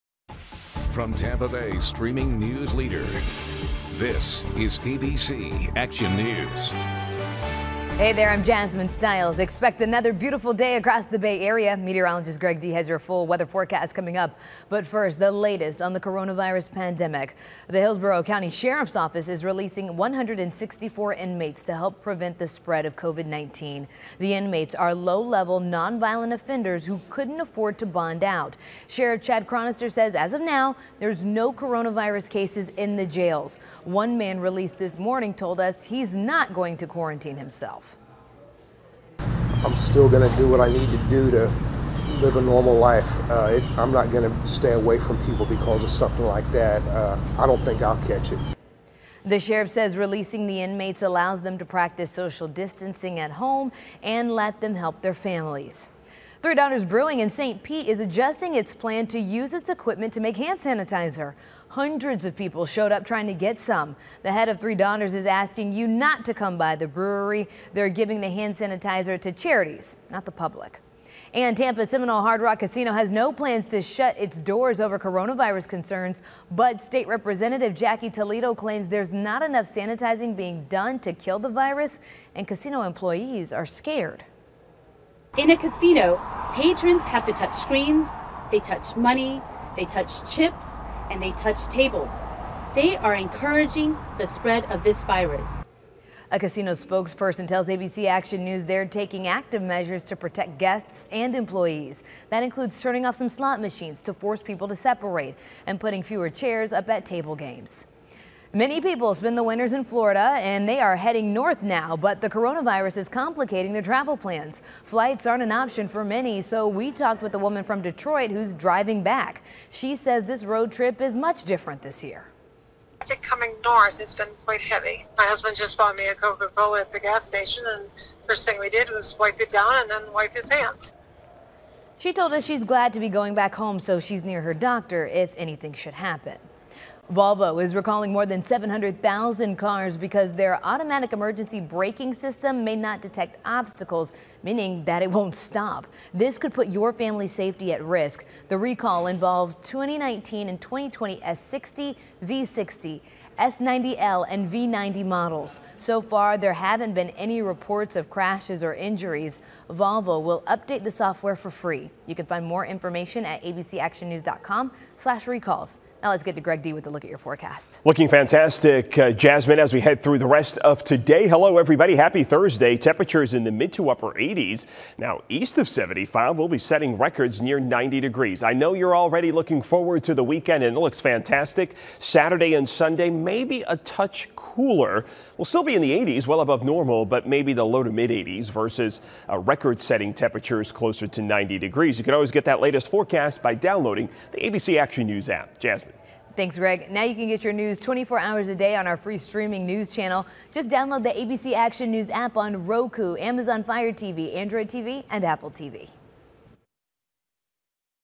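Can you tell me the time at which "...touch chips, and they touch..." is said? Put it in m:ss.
1:29.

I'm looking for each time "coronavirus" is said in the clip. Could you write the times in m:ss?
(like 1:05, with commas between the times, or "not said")
0:15, 0:31, 1:14, 1:52.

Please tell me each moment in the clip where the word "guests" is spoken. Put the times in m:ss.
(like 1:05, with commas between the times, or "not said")
1:40.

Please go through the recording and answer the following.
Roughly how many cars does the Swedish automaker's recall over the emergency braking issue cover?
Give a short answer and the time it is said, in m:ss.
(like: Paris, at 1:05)
700,000, at 2:18.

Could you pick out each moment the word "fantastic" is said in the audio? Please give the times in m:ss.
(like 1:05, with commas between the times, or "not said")
2:48, 3:00.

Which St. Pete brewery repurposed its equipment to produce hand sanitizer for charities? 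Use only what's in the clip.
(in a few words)
Three Daughters Brewing.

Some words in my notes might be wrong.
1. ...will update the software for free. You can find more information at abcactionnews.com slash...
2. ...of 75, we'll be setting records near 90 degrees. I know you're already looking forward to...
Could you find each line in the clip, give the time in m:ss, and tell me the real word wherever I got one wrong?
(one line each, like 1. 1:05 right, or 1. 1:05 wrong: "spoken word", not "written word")
1. 2:40 right
2. 2:55 right.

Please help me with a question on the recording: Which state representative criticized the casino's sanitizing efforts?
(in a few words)
Jackie Toledo.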